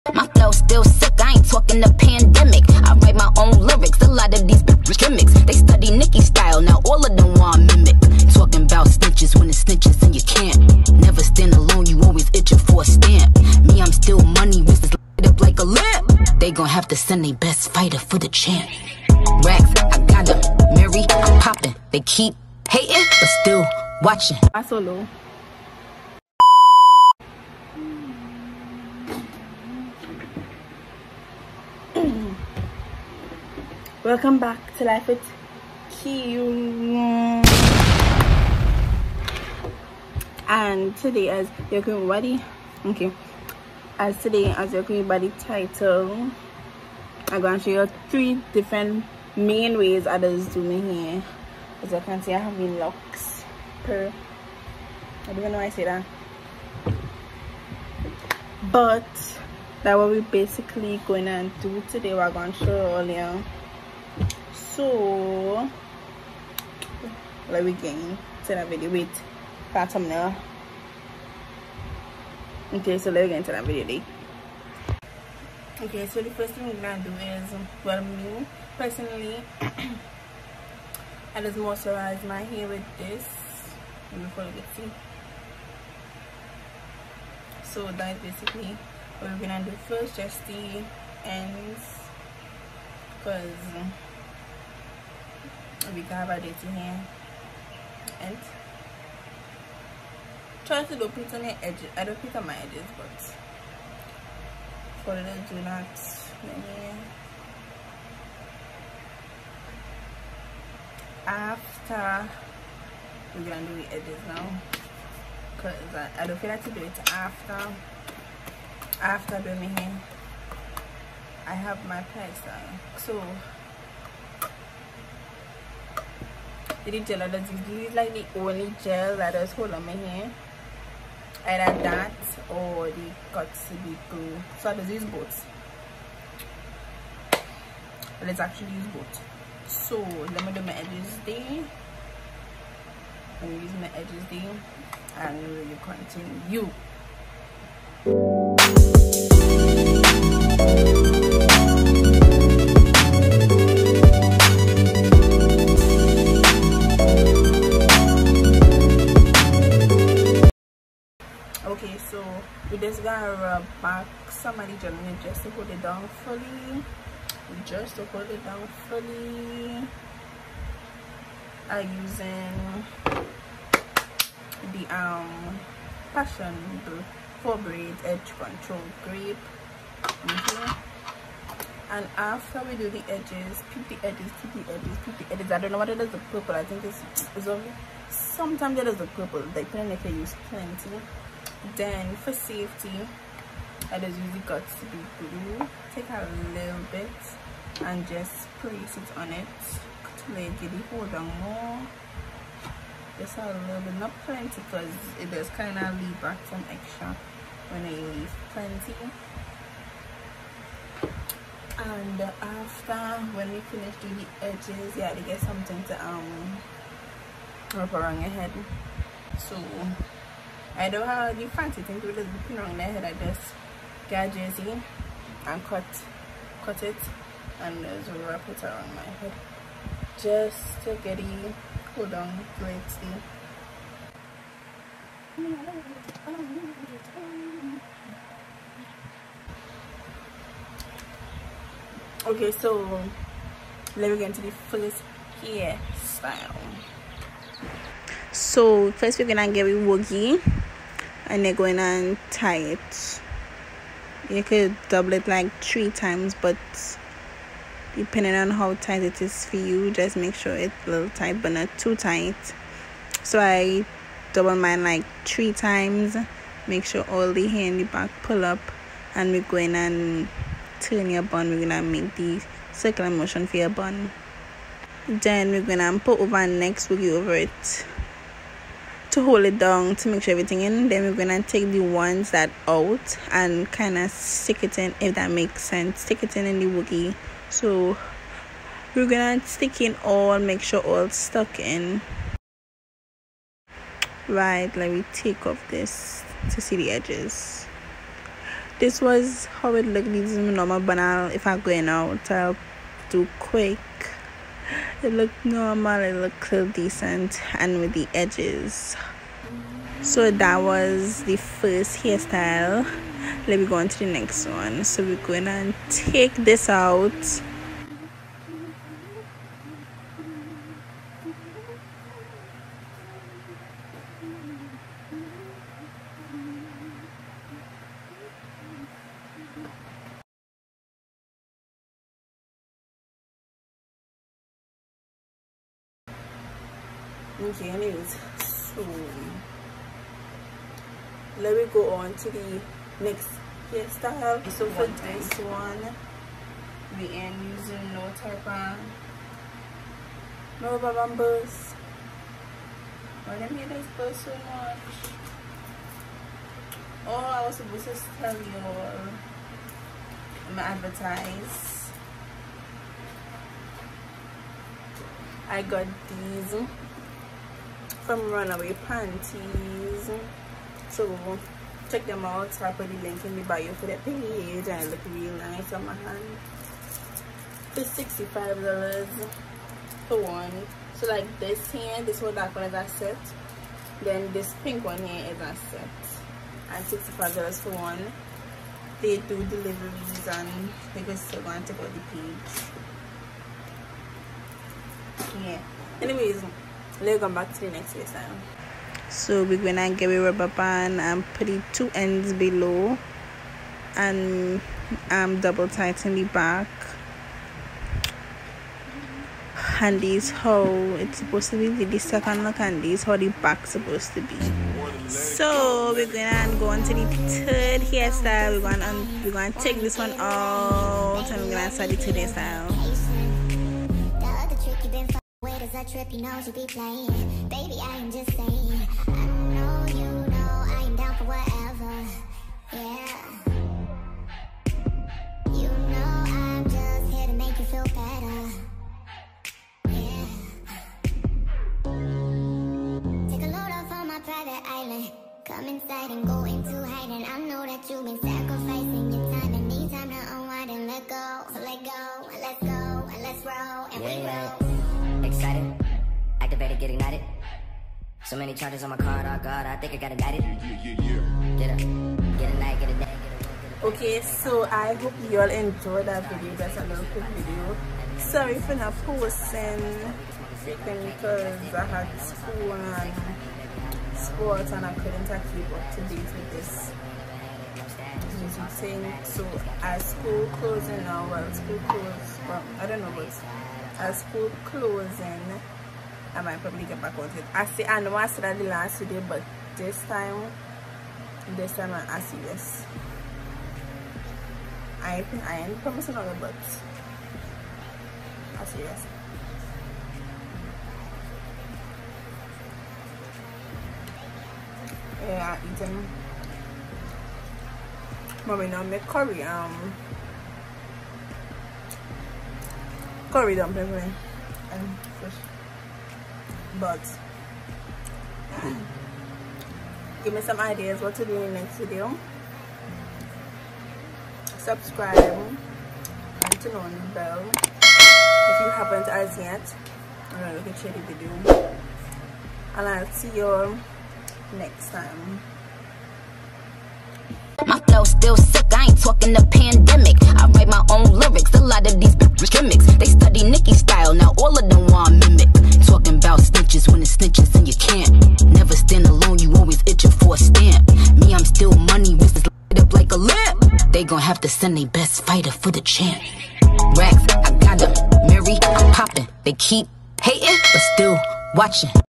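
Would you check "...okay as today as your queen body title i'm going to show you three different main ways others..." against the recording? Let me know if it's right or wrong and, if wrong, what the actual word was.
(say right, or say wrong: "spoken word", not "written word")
right.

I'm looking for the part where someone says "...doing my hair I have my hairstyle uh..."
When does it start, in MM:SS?
01:59.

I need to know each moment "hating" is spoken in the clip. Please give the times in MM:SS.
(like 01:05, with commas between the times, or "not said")
00:22, 09:20.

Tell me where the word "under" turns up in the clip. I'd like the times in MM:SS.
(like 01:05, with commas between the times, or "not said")
02:07.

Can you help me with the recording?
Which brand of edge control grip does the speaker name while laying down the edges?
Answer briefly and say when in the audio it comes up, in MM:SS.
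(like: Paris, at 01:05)
Passion for braid, at 02:56.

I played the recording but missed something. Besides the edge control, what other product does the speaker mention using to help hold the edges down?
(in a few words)
Got2b glue.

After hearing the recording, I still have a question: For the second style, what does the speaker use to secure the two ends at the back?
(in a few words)
A rubber band.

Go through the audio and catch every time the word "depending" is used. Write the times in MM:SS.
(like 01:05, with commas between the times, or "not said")
03:09, 04:17.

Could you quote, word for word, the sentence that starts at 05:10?
So that was the first hairstyle.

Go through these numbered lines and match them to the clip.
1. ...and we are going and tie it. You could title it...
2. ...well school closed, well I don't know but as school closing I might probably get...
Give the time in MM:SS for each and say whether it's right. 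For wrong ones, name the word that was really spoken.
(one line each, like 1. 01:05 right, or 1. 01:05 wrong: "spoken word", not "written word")
1. 04:11 wrong: "double", not "title"
2. 08:01 right.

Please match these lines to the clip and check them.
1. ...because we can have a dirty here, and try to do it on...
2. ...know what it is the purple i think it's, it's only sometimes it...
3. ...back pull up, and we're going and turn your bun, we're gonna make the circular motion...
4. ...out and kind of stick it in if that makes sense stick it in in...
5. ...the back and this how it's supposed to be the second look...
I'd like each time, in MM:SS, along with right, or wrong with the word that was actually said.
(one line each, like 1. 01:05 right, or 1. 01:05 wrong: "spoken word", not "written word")
1. 01:33 right
2. 03:05 right
3. 04:27 right
4. 04:42 right
5. 06:46 right.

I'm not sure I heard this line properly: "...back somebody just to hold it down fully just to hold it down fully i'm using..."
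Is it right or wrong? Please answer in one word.
right.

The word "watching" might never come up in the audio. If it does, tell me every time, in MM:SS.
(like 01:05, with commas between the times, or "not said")
00:24, 09:21.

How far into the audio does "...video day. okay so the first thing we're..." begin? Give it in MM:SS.
01:13.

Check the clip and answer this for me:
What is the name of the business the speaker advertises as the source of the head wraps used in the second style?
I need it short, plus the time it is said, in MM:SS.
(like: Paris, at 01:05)
Runway Panties, at 06:08.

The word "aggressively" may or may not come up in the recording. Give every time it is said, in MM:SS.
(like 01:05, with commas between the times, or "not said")
not said.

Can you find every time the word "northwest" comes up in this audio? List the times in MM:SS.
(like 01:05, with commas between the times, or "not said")
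not said.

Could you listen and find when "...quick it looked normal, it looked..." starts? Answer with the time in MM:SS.
05:03.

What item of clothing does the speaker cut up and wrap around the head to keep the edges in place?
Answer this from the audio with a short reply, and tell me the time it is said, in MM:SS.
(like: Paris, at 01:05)
A jersey, at 03:44.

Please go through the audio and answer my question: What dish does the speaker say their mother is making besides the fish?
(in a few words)
Curry dumpling.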